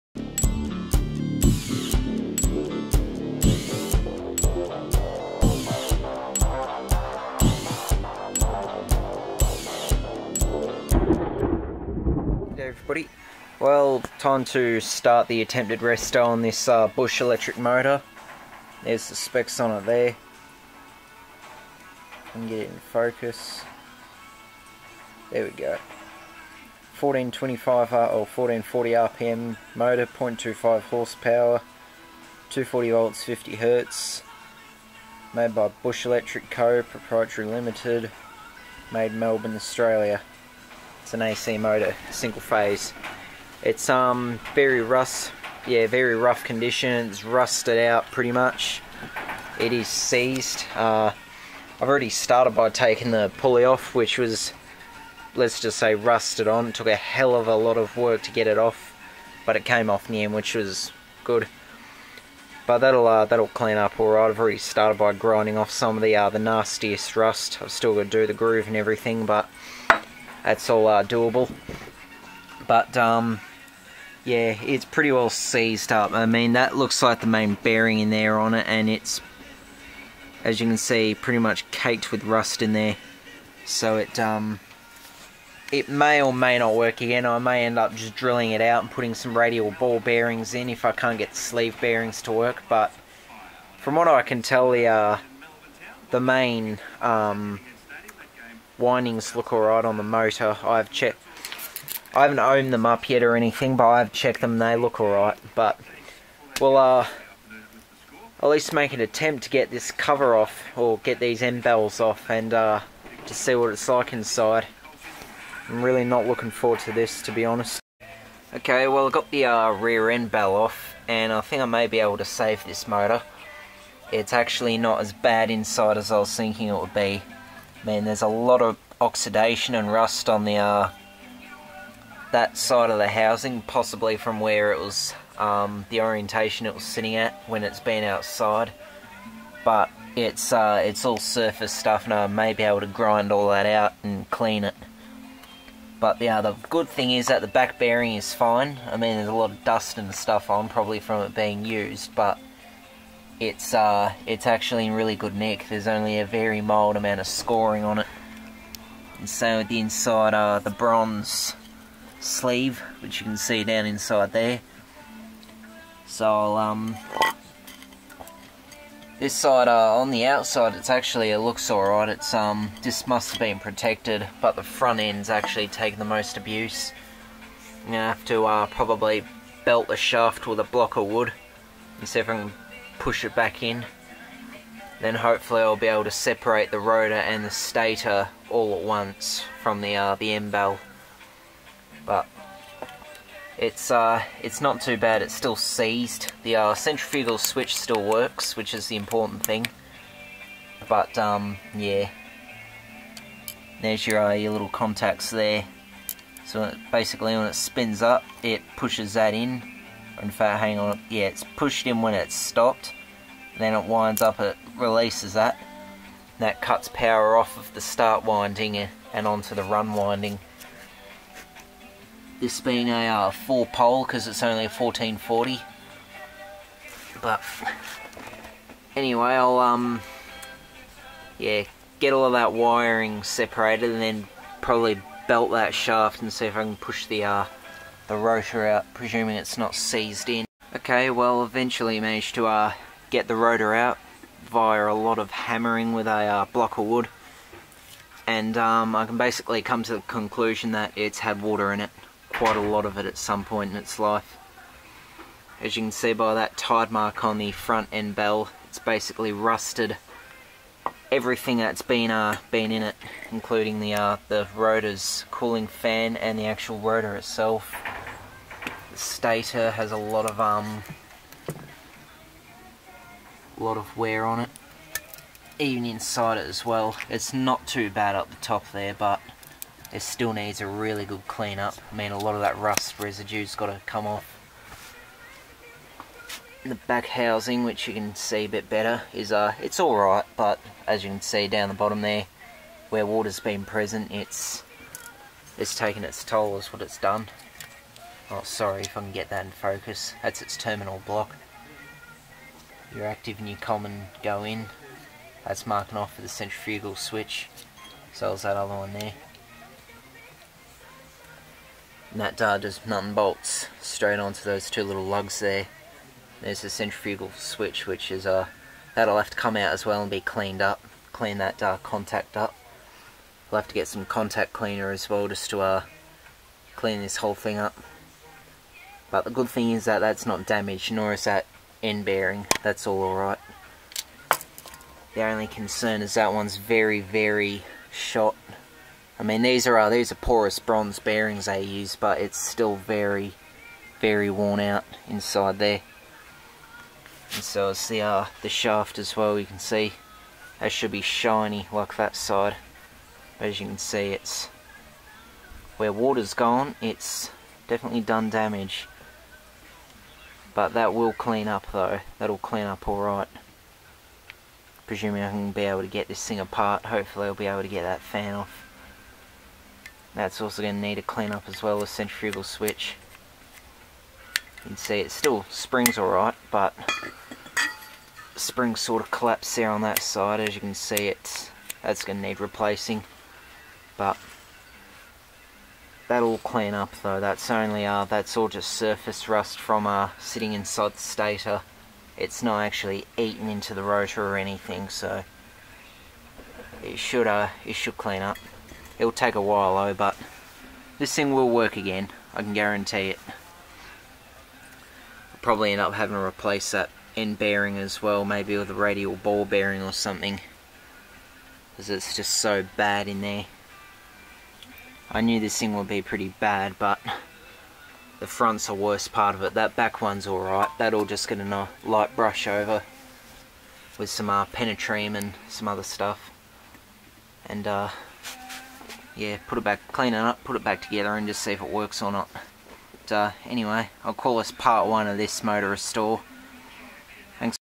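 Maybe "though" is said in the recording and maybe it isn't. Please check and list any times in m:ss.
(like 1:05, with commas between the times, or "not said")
6:01, 6:27, 6:39.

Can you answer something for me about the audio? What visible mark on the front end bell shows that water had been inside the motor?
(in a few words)
tide mark.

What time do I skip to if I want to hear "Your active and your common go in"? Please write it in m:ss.
5:02.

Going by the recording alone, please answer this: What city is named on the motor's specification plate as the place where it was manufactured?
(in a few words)
Melbourne.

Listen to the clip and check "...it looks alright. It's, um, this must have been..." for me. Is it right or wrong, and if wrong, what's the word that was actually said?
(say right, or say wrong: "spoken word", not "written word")
right.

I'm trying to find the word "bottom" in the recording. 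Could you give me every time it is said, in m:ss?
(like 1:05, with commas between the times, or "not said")
4:51.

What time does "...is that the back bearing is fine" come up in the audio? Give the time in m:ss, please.
2:27.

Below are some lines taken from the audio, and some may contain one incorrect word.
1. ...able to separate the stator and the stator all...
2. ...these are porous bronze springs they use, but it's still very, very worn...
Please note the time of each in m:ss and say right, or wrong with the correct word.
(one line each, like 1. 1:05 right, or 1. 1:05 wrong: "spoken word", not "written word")
1. 3:05 wrong: "rotor", not "stator"
2. 5:39 wrong: "bearings", not "springs".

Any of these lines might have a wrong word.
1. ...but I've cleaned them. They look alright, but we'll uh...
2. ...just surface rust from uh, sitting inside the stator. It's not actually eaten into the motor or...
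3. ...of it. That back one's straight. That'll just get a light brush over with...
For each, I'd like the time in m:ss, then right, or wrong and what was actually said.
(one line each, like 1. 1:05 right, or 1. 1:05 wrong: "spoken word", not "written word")
1. 1:43 wrong: "checked", not "cleaned"
2. 6:28 wrong: "rotor", not "motor"
3. 6:59 wrong: "alright", not "straight".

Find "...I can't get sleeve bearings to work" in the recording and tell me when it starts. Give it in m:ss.
1:30.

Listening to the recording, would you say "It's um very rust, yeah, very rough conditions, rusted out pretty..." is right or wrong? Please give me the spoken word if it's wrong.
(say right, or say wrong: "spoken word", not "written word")
right.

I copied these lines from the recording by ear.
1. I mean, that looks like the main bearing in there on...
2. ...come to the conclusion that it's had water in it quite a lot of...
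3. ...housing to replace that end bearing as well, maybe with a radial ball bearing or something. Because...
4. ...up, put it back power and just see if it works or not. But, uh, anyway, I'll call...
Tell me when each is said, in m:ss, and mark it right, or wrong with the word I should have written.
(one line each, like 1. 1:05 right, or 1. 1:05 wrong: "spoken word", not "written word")
1. 1:16 right
2. 4:09 right
3. 6:45 wrong: "having", not "housing"
4. 7:10 wrong: "together", not "power".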